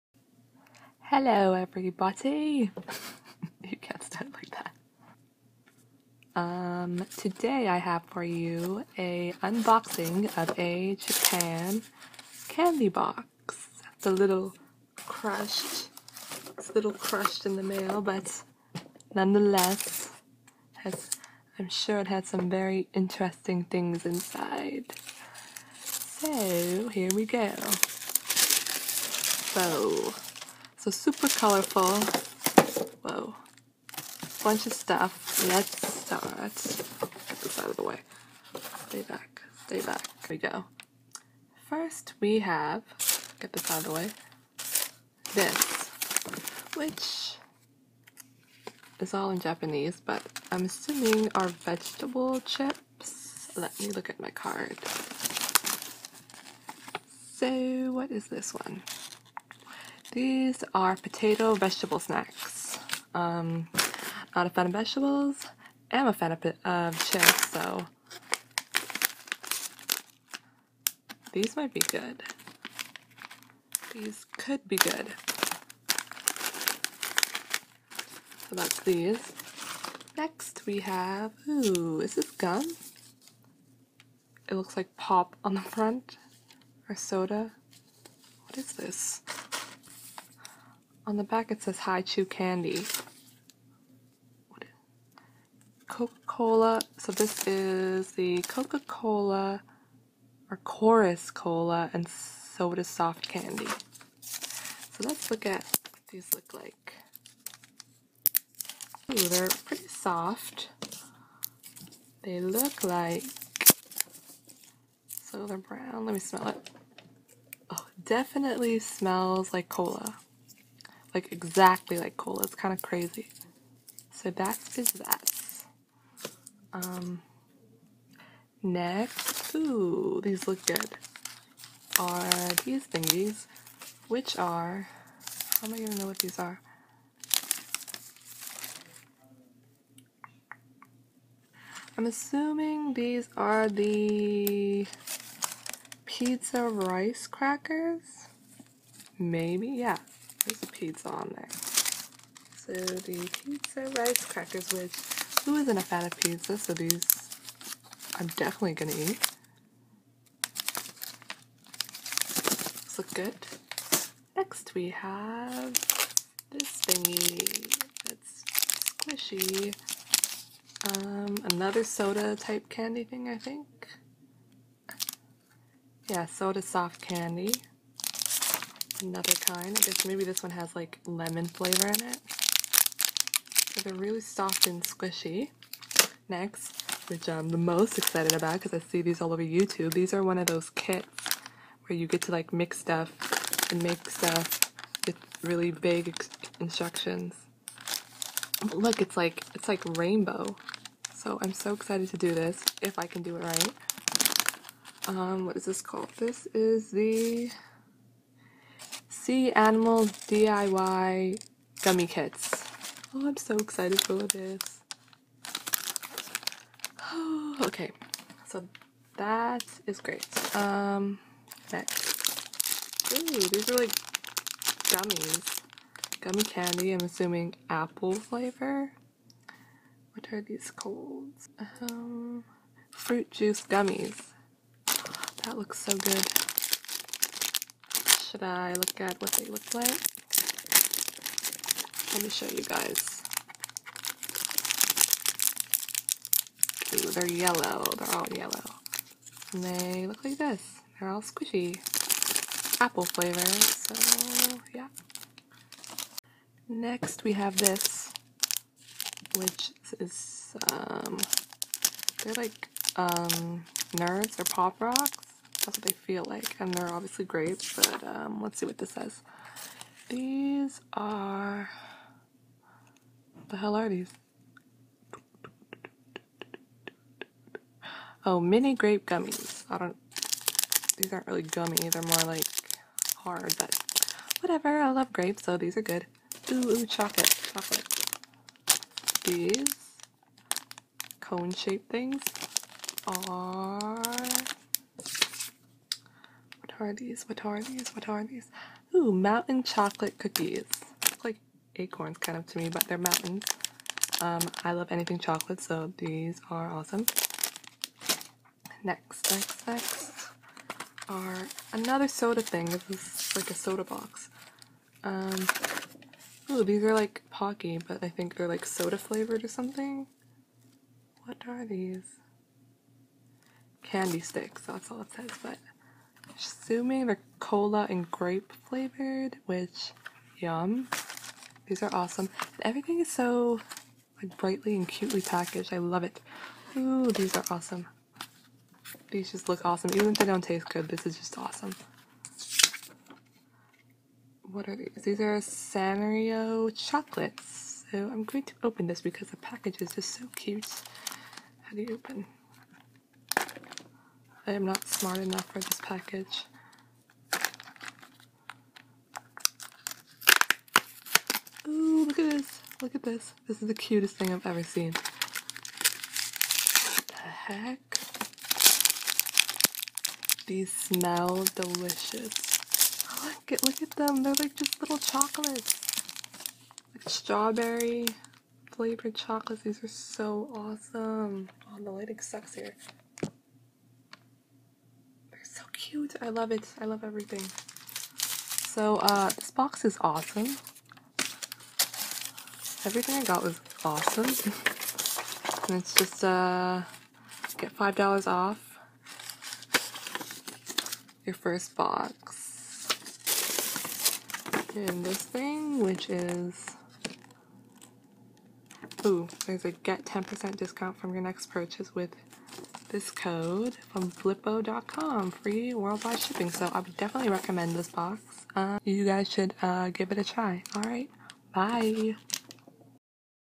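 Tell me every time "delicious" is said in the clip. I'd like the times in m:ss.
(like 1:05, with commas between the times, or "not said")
6:11.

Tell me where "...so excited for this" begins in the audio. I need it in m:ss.
3:33.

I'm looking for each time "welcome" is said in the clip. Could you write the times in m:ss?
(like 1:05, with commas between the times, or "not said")
not said.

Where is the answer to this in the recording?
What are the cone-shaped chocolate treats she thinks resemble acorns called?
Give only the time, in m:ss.
4:59.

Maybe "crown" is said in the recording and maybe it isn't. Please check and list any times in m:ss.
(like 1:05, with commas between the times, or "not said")
not said.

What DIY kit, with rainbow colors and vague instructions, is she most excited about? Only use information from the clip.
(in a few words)
sea animal DIY gummy kits.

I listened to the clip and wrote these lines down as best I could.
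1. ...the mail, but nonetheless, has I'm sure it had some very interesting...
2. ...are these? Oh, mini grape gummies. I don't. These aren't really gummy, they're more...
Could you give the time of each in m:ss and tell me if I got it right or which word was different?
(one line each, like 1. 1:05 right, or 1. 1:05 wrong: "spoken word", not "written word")
1. 0:17 right
2. 4:33 right.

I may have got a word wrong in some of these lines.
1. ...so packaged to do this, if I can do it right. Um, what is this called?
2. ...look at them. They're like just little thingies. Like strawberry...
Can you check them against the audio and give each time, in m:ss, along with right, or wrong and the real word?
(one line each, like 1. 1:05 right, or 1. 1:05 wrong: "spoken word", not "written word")
1. 3:21 wrong: "excited", not "packaged"
2. 6:13 wrong: "chocolates", not "thingies".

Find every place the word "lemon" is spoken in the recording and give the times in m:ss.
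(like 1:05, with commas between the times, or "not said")
3:01.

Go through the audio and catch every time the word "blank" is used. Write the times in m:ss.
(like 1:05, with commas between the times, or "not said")
not said.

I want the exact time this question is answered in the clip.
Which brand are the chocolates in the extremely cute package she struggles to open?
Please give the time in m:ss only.
5:45.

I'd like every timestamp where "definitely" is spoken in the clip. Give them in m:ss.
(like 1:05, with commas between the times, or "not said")
1:58, 2:38, 6:56.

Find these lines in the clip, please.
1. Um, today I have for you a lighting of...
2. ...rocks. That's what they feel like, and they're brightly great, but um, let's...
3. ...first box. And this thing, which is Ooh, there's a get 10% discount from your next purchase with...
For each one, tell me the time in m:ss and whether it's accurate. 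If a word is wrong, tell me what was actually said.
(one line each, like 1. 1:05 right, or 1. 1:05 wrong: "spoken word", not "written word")
1. 0:06 wrong: "unboxing", not "lighting"
2. 4:24 wrong: "obviously", not "brightly"
3. 6:41 right.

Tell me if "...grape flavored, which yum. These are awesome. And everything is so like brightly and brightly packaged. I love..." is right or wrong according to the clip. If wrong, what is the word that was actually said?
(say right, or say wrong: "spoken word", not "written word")
wrong: "cutely", not "brightly".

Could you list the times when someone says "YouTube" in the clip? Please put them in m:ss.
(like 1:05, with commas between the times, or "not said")
3:09.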